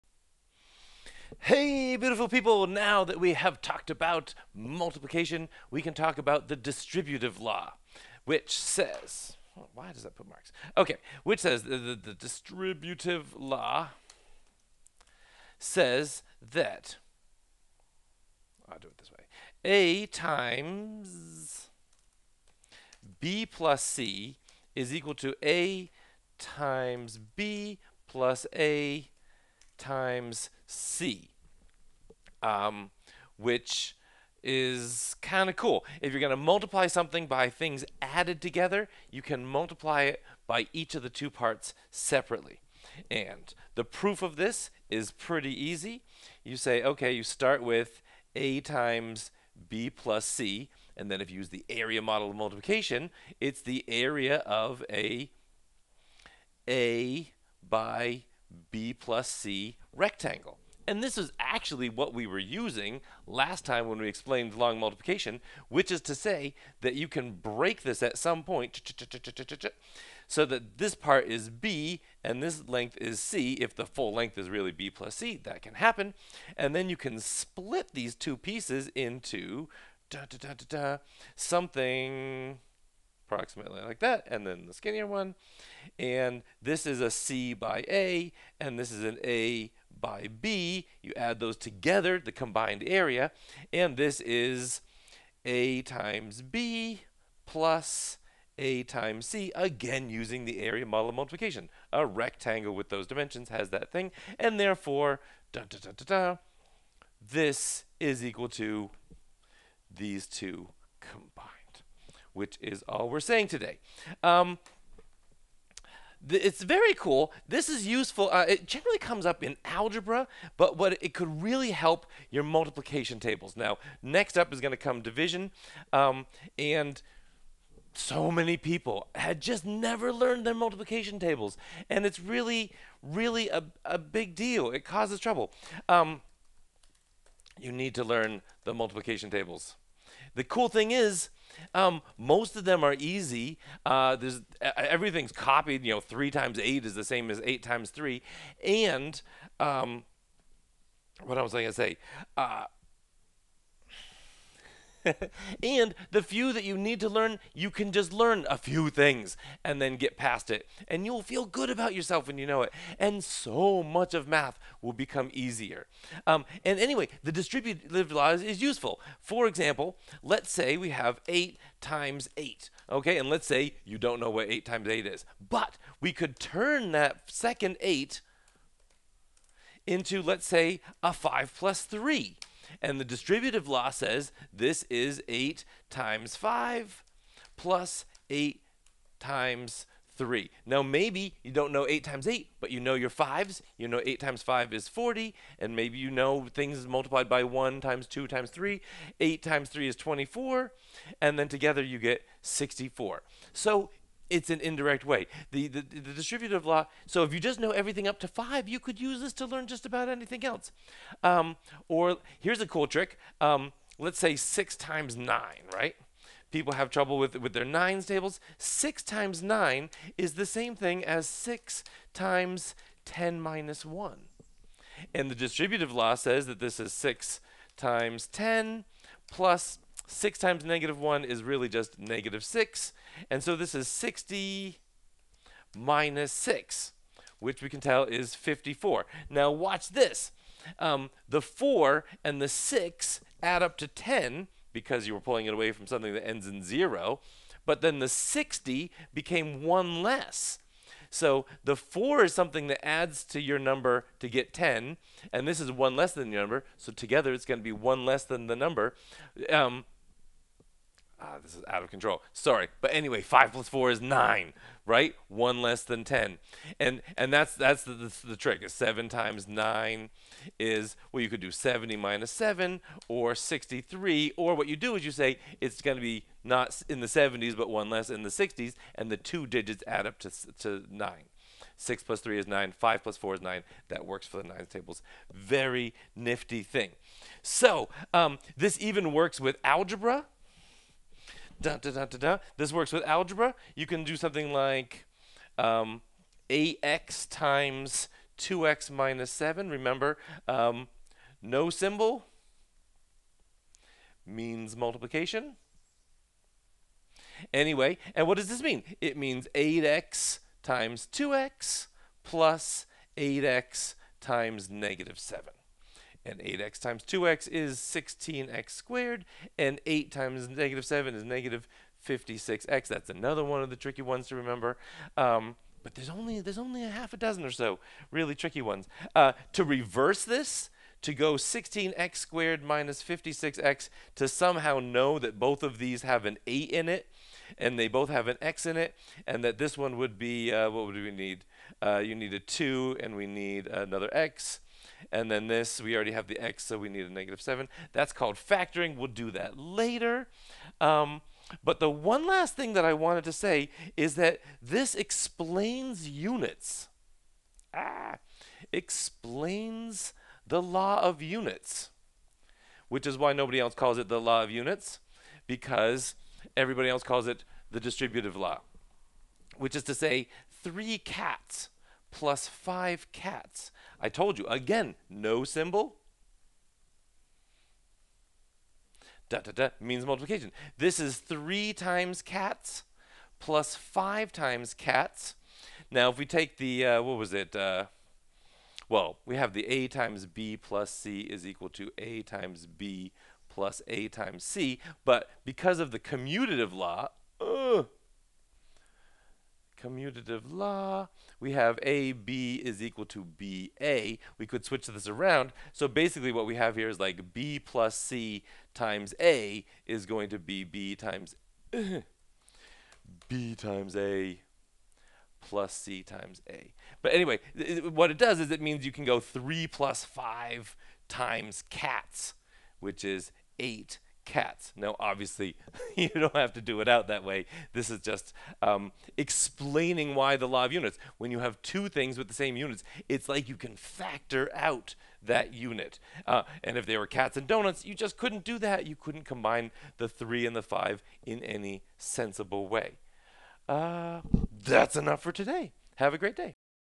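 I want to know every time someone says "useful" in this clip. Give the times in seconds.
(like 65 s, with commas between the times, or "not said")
117 s, 168 s.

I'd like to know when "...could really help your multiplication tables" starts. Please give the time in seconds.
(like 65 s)
121 s.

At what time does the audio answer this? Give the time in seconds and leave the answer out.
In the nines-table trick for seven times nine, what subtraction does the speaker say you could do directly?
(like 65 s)
271 s.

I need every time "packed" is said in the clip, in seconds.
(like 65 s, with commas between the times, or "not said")
not said.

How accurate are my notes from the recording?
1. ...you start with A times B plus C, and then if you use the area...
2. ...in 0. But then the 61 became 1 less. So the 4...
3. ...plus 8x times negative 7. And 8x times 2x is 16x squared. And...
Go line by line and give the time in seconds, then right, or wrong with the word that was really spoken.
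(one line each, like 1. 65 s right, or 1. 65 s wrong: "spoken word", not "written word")
1. 47 s right
2. 246 s wrong: "60", not "61"
3. 312 s right.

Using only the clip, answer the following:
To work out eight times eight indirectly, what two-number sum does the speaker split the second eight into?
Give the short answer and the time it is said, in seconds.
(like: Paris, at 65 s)
5 plus 3, at 181 s.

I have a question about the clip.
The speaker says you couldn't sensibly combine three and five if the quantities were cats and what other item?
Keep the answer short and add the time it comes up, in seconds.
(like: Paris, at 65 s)
Donuts, at 437 s.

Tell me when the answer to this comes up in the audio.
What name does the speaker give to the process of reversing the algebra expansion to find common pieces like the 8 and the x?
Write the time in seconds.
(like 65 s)
348 s.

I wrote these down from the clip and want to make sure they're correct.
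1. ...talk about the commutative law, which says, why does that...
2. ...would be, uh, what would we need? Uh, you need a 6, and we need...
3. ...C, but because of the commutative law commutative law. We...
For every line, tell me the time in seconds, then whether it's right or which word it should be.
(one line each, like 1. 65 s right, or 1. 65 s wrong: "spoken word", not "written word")
1. 5 s wrong: "distributive", not "commutative"
2. 339 s wrong: "2", not "6"
3. 394 s right.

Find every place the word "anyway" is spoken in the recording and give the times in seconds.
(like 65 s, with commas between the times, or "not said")
166 s, 262 s, 307 s, 417 s.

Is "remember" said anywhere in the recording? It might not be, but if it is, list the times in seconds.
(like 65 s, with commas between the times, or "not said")
299 s, 324 s.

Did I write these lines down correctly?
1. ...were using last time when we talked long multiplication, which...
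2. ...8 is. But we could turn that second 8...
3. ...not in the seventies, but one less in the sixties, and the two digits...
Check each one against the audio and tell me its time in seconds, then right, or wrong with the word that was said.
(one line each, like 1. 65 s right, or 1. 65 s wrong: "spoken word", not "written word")
1. 62 s wrong: "explained", not "talked"
2. 174 s right
3. 276 s right.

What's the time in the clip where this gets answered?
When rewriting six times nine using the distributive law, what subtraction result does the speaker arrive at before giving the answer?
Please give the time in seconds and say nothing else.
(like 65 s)
233 s.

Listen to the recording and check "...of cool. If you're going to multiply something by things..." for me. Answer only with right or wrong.
right.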